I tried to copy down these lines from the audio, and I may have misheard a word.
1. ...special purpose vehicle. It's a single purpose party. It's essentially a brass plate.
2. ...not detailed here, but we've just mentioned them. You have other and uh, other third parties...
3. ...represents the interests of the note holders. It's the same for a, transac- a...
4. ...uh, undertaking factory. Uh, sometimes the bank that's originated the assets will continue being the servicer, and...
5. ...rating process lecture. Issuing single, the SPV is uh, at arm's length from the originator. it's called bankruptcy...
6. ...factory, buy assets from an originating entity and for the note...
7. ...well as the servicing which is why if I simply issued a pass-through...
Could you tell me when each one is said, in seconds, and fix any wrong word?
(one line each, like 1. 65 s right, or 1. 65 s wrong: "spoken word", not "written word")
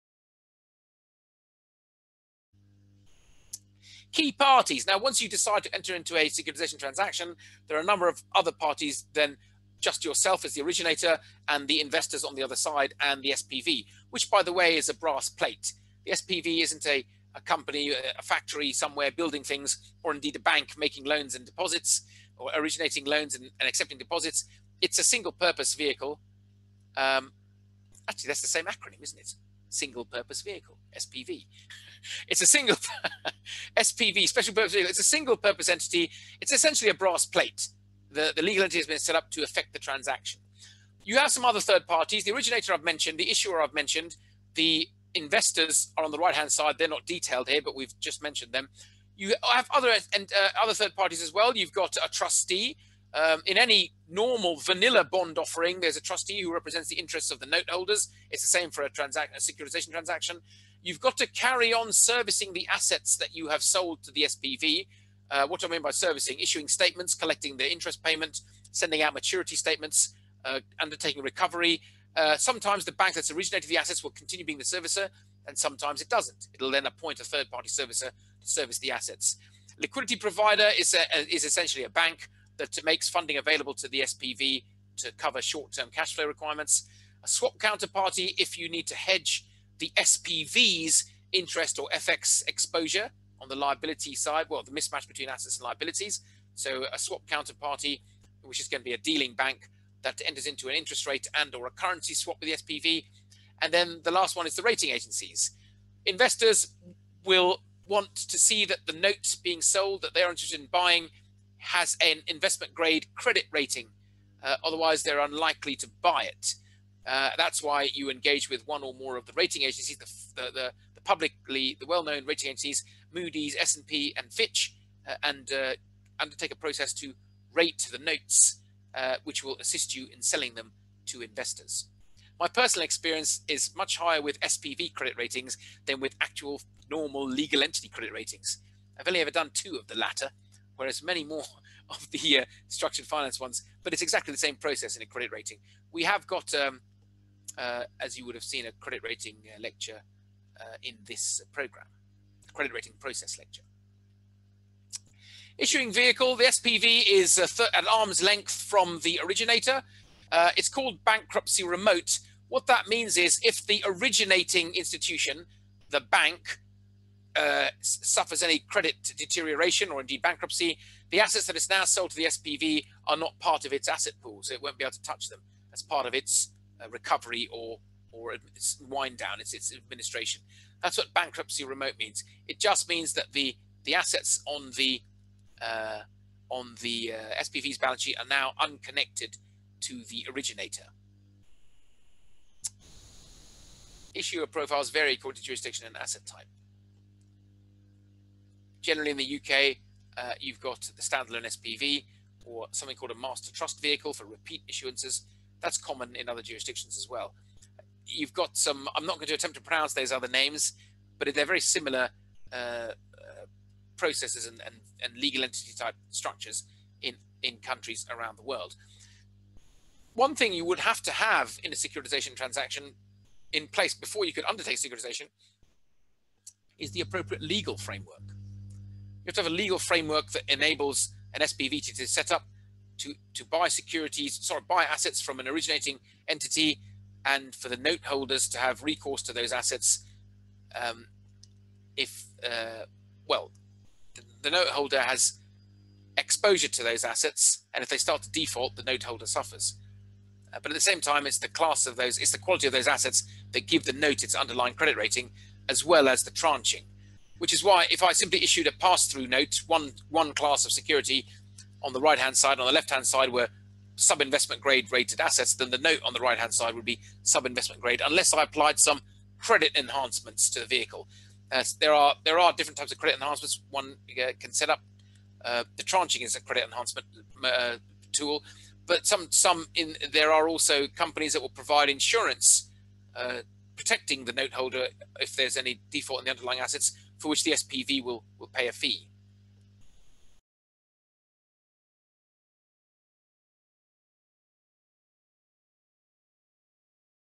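1. 34 s wrong: "entity", not "party"
2. 46 s right
3. 56 s right
4. 70 s wrong: "recovery", not "factory"
5. 152 s wrong: "vehicle", not "single"
6. 234 s wrong: "sorry", not "factory"
7. 255 s wrong: "tranching", not "servicing".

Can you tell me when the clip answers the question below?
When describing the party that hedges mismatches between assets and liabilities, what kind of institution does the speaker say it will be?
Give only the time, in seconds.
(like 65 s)
98 s.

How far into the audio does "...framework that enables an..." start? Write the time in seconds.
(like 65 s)
229 s.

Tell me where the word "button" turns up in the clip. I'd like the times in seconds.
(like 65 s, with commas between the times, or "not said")
not said.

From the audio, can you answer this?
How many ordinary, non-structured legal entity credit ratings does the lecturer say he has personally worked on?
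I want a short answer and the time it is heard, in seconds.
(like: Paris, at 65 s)
2, at 139 s.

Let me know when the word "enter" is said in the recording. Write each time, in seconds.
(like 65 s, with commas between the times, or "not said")
5 s, 100 s.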